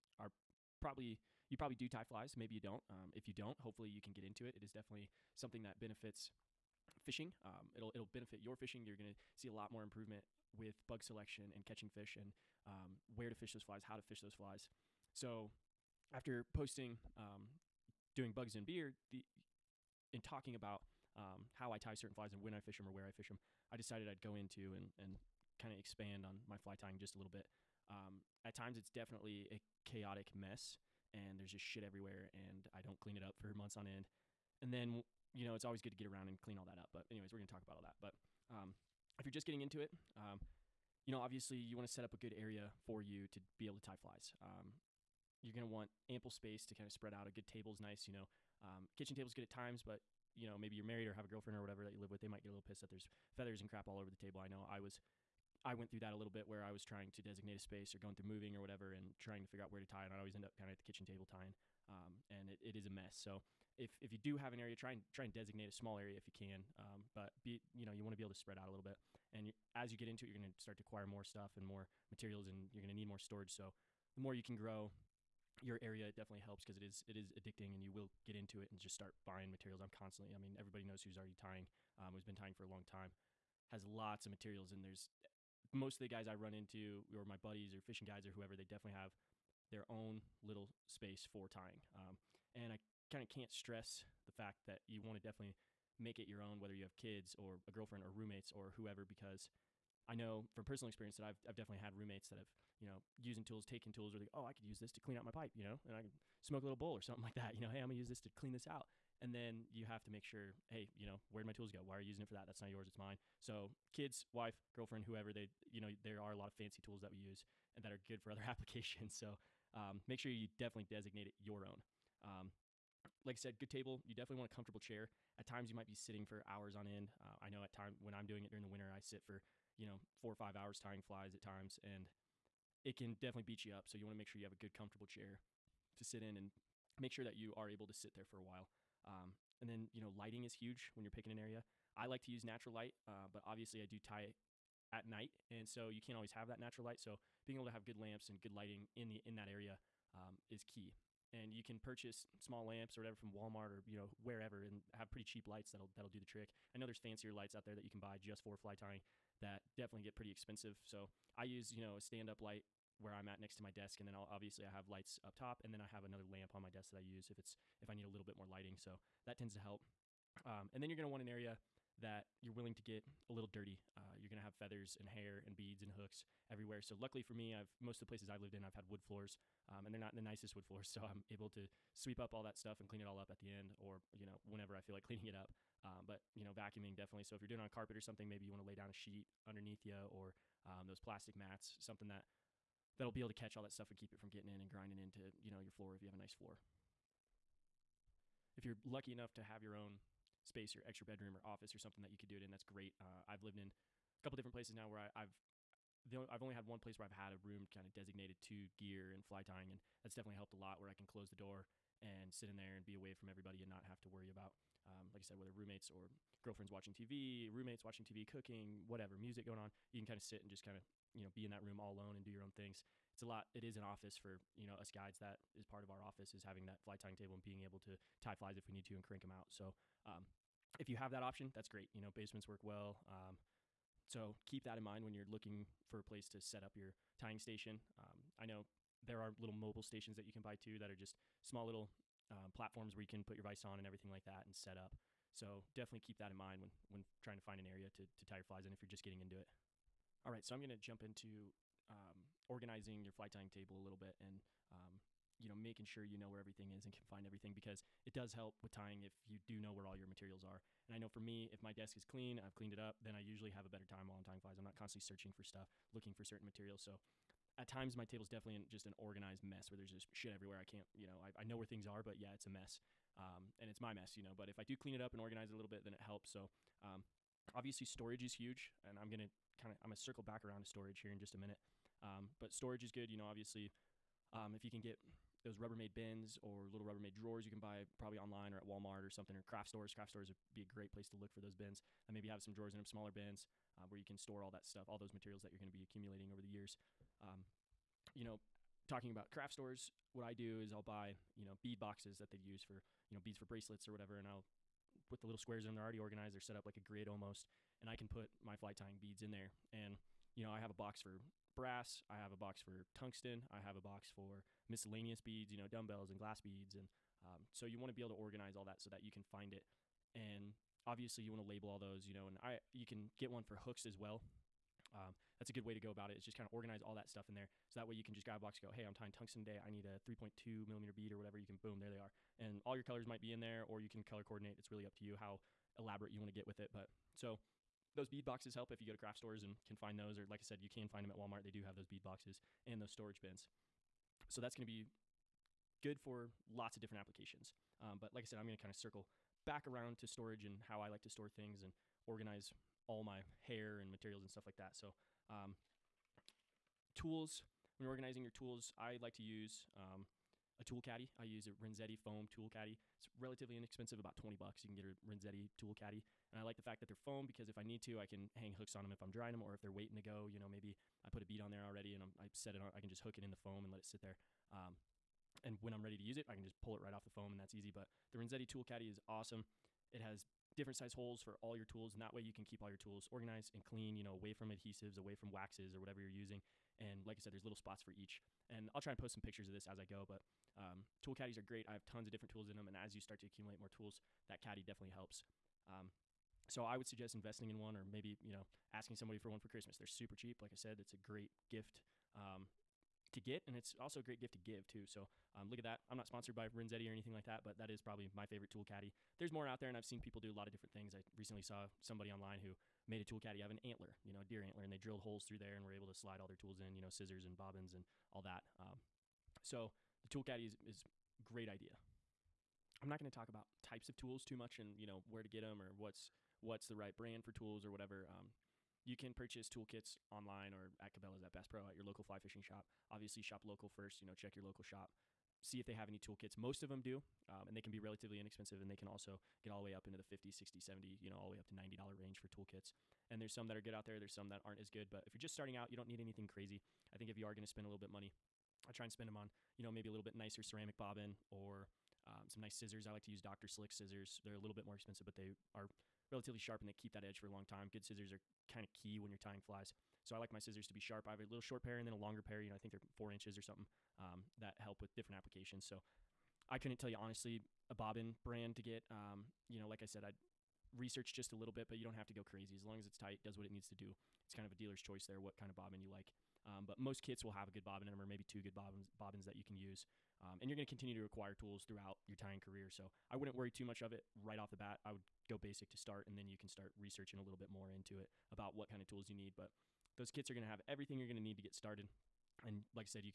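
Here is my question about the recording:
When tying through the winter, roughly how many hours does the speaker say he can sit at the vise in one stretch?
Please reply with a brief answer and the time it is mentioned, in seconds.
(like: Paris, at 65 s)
4 or 5 hours, at 130 s.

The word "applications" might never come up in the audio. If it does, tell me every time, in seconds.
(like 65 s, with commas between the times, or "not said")
118 s, 346 s, 465 s.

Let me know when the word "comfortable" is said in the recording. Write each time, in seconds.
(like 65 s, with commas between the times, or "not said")
124 s, 134 s.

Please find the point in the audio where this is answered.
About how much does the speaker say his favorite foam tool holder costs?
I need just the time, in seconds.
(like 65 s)
363 s.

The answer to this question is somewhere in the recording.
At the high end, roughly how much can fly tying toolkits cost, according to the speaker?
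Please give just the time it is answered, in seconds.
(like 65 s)
441 s.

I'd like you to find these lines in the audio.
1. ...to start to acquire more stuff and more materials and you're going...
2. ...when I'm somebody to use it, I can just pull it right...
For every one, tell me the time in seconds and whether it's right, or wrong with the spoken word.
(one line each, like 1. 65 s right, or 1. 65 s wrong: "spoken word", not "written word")
1. 70 s right
2. 375 s wrong: "ready", not "somebody".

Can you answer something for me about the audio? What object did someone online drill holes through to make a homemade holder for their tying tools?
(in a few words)
A deer antler.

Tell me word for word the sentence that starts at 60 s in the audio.
And I'd always end up kind of at the kitchen table tying.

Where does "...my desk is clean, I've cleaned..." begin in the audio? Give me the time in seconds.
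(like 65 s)
261 s.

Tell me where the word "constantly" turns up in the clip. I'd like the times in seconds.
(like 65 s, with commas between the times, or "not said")
79 s, 264 s.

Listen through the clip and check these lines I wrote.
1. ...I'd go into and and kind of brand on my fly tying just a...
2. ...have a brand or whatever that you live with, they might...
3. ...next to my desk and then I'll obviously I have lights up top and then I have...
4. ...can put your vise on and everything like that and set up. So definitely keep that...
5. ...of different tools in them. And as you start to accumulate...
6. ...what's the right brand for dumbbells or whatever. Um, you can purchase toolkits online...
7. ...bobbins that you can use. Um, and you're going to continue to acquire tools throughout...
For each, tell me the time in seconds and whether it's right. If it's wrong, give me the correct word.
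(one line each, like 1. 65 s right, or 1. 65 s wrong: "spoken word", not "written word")
1. 24 s wrong: "expand", not "brand"
2. 51 s wrong: "girlfriend", not "brand"
3. 163 s right
4. 243 s right
5. 392 s right
6. 426 s wrong: "tools", not "dumbbells"
7. 478 s right.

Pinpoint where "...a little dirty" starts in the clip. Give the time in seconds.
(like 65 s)
173 s.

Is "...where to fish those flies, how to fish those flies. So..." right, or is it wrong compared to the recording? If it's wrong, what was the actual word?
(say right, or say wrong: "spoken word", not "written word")
right.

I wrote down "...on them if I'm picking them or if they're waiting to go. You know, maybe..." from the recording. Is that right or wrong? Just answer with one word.
wrong.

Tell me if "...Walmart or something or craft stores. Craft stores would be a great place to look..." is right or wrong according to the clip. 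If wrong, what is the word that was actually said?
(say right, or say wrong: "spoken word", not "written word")
right.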